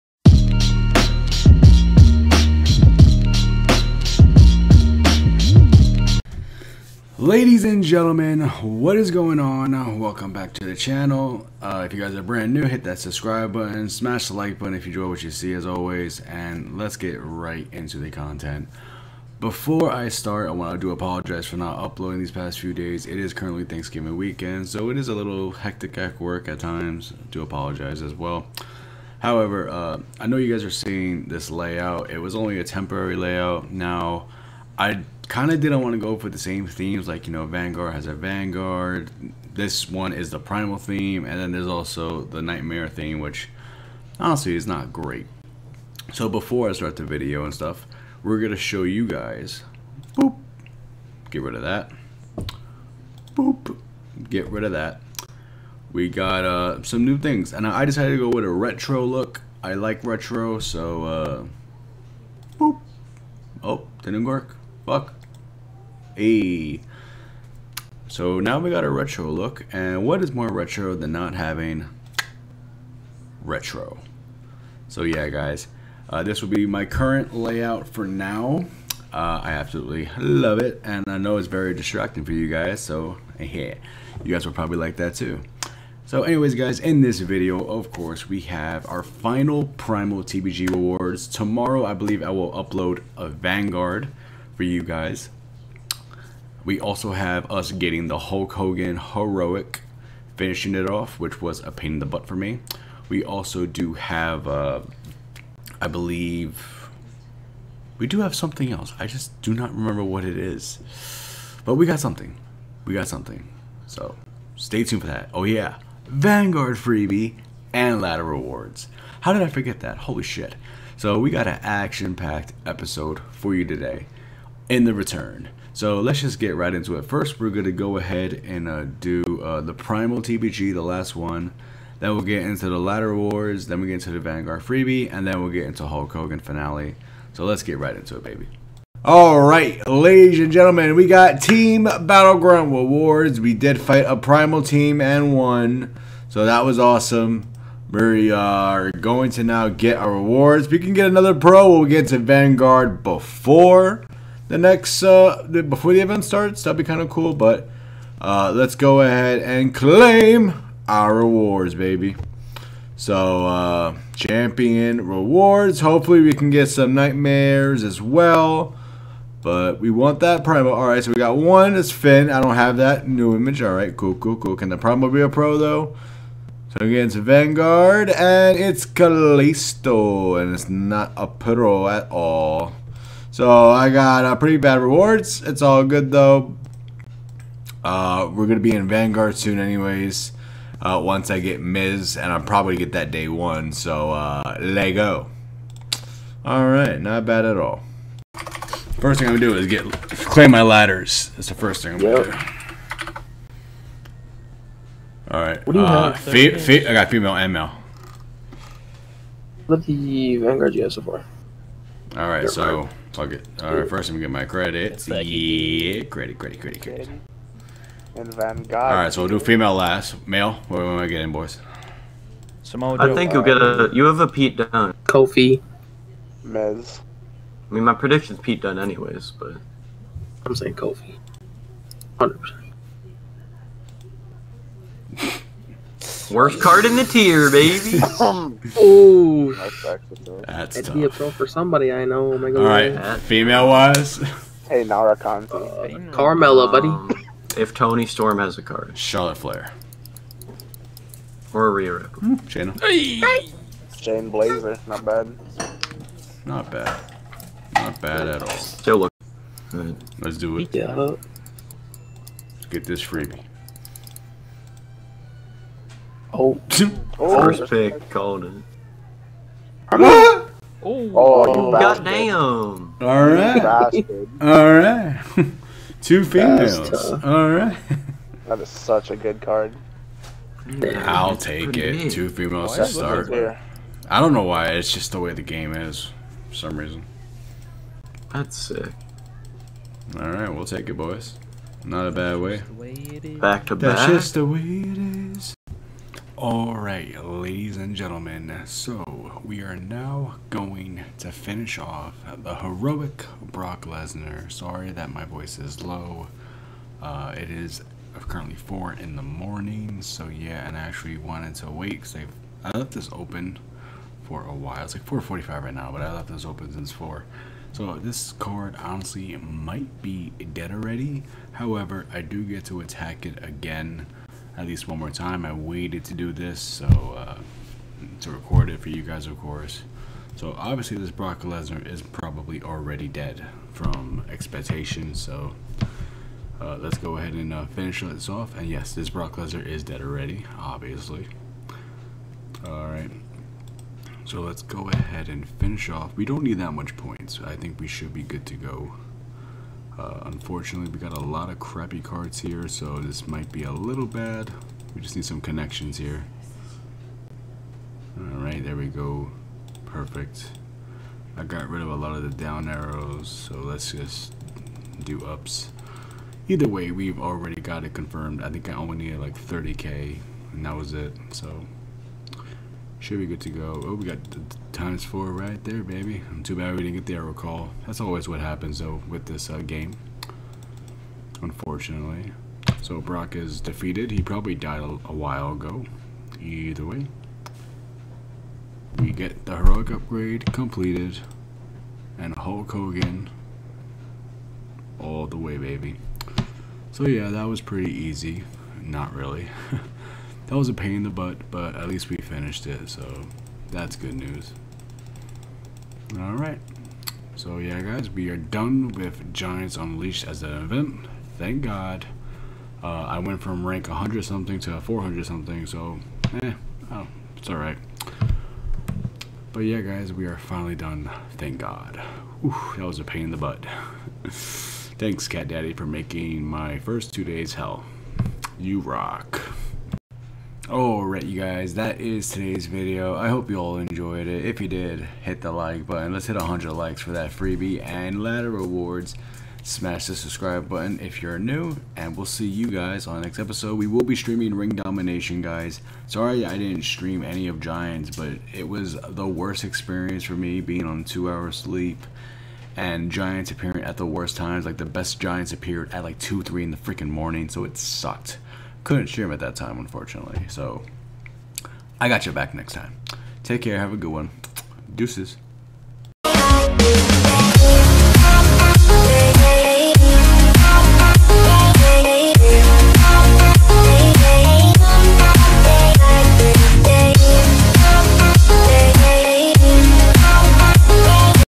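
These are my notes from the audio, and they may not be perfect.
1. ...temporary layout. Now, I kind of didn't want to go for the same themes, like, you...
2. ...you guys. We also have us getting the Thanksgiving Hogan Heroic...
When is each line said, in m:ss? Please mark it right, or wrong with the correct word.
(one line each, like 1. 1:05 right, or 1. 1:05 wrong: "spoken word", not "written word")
1. 0:32 right
2. 1:34 wrong: "Hulk", not "Thanksgiving".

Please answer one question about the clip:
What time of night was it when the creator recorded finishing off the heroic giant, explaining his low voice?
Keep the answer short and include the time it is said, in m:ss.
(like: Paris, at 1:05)
4 in the morning, at 5:08.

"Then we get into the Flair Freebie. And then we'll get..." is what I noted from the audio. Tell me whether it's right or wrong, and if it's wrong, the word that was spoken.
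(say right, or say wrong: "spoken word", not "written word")
wrong: "Vanguard", not "Flair".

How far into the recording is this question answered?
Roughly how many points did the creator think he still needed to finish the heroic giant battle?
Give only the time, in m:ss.
6:09.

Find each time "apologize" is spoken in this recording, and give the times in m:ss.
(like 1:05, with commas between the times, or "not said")
0:20, 0:27.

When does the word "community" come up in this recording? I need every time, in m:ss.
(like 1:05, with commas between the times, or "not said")
not said.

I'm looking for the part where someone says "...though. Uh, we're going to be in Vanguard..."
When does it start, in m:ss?
3:06.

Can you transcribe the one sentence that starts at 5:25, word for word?
I waited to do this so uh, to record it for you guys, of course.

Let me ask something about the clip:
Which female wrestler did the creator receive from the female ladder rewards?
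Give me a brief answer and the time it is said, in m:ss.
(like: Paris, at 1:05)
Shayna Baszler, at 4:13.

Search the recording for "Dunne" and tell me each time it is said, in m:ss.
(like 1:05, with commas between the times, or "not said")
3:44, 3:48.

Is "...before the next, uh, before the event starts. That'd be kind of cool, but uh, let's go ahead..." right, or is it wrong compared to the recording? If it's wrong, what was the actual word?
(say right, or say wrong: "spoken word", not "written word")
right.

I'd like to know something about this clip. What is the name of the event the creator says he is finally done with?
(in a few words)
Giants Unleashed.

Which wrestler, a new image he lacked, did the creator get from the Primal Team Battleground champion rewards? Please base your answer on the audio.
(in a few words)
Finn.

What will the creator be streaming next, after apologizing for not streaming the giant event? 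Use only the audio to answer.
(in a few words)
Ring Domination.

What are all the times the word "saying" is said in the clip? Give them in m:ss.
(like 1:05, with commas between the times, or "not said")
3:50.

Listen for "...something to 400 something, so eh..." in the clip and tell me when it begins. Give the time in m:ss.
6:54.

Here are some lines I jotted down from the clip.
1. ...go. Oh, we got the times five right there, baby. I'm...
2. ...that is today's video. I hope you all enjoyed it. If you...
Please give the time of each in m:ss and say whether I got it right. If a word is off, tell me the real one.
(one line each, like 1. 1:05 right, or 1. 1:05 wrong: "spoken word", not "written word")
1. 6:13 wrong: "four", not "five"
2. 7:11 right.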